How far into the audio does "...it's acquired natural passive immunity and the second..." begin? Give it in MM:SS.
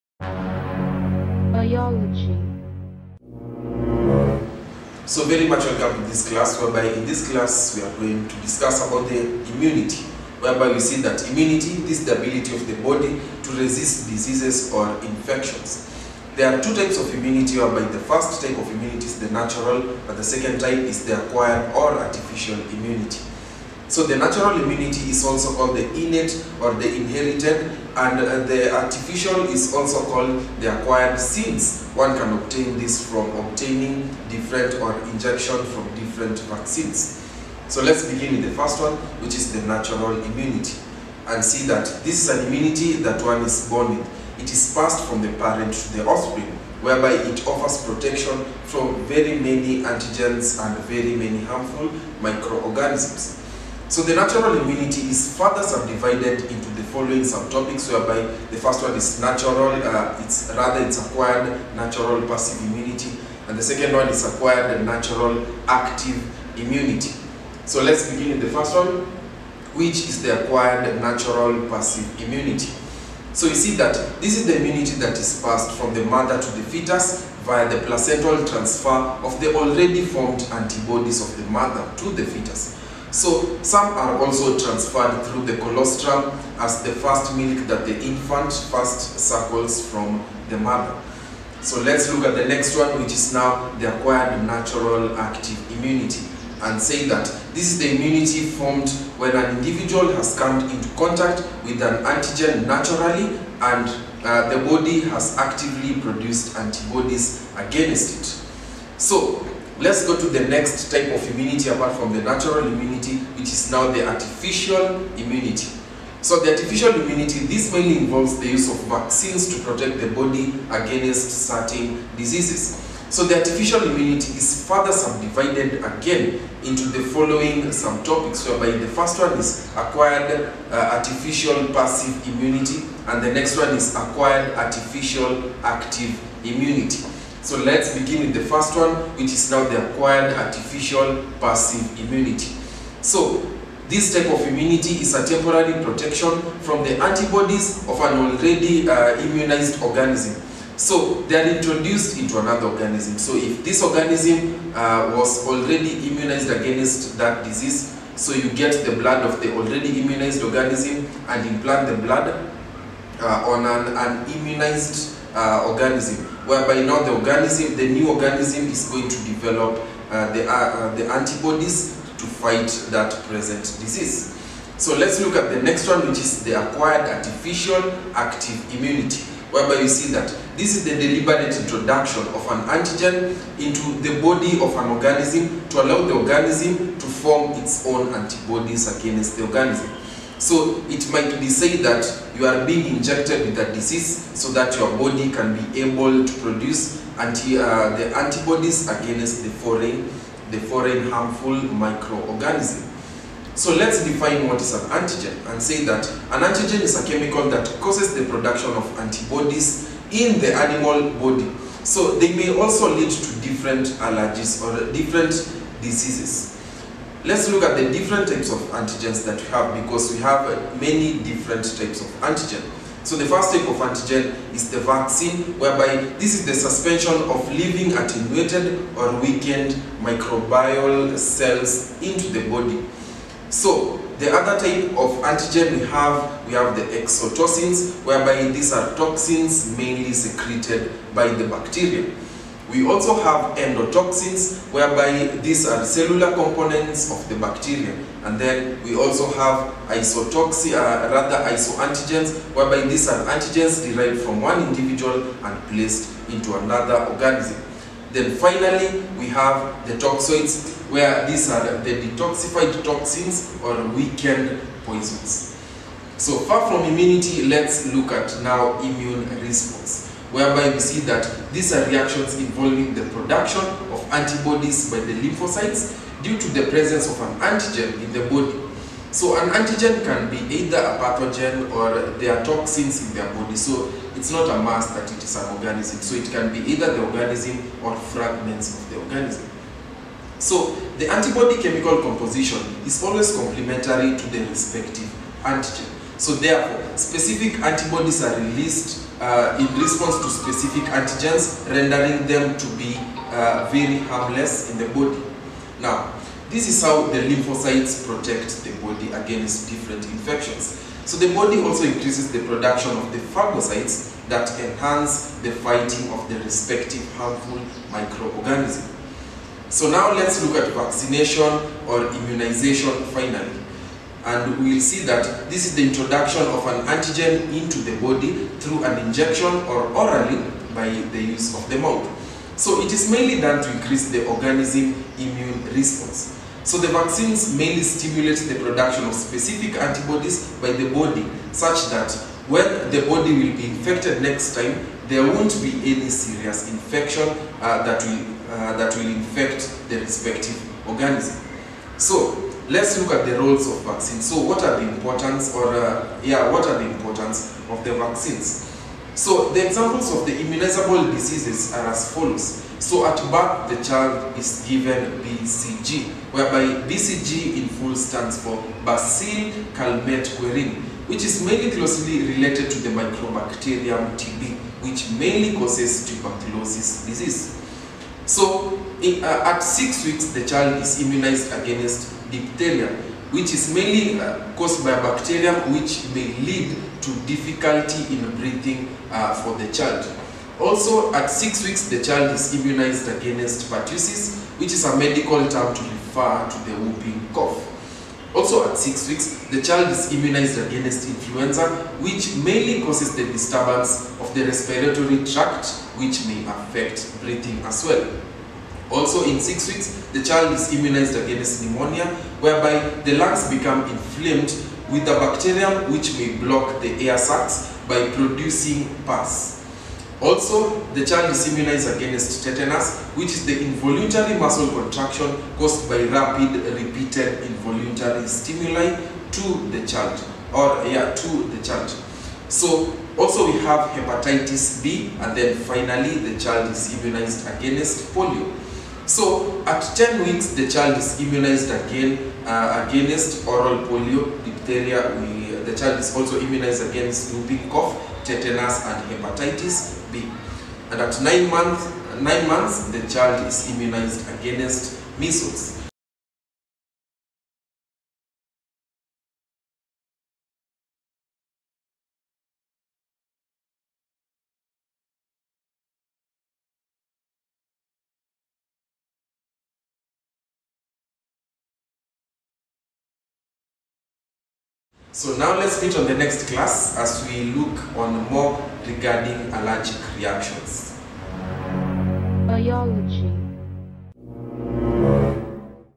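01:00.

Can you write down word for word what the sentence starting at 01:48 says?
So Let's go to the next type of immunity apart from the natural immunity, which is now the artificial immunity.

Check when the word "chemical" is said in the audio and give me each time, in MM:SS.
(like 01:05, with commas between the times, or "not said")
03:27, 04:51.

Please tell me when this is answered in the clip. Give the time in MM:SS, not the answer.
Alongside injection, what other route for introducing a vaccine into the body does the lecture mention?
05:29.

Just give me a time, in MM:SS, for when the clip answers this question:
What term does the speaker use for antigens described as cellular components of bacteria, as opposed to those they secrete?
04:03.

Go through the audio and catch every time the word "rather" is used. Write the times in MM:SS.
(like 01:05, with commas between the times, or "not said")
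01:00, 04:11.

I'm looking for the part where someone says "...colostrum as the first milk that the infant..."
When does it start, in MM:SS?
01:25.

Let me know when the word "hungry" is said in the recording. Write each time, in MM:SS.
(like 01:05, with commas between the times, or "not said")
not said.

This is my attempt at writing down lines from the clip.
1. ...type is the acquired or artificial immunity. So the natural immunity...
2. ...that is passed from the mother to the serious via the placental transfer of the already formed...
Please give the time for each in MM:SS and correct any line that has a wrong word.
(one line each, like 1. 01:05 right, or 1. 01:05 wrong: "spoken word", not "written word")
1. 00:20 right
2. 01:15 wrong: "fetus", not "serious".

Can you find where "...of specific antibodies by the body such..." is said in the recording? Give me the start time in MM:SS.
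05:39.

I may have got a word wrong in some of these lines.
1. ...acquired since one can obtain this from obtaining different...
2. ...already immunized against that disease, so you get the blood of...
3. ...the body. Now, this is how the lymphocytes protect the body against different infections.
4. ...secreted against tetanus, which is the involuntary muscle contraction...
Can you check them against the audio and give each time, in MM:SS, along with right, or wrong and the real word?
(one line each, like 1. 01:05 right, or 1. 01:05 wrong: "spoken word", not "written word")
1. 00:30 right
2. 02:35 right
3. 05:04 right
4. 07:01 wrong: "immunized", not "secreted".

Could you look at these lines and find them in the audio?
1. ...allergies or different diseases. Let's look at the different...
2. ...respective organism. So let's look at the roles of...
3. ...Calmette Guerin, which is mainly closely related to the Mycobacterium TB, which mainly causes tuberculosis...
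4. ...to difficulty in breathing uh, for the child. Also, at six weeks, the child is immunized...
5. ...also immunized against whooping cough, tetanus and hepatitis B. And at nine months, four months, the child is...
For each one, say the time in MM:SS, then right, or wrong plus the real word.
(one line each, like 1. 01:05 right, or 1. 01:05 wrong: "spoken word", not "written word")
1. 03:34 right
2. 05:49 right
3. 06:09 right
4. 06:27 right
5. 07:26 wrong: "nine", not "four".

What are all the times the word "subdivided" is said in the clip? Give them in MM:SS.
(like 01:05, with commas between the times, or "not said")
00:55, 02:04.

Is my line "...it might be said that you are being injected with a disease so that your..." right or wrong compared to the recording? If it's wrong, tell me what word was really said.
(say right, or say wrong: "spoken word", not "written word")
right.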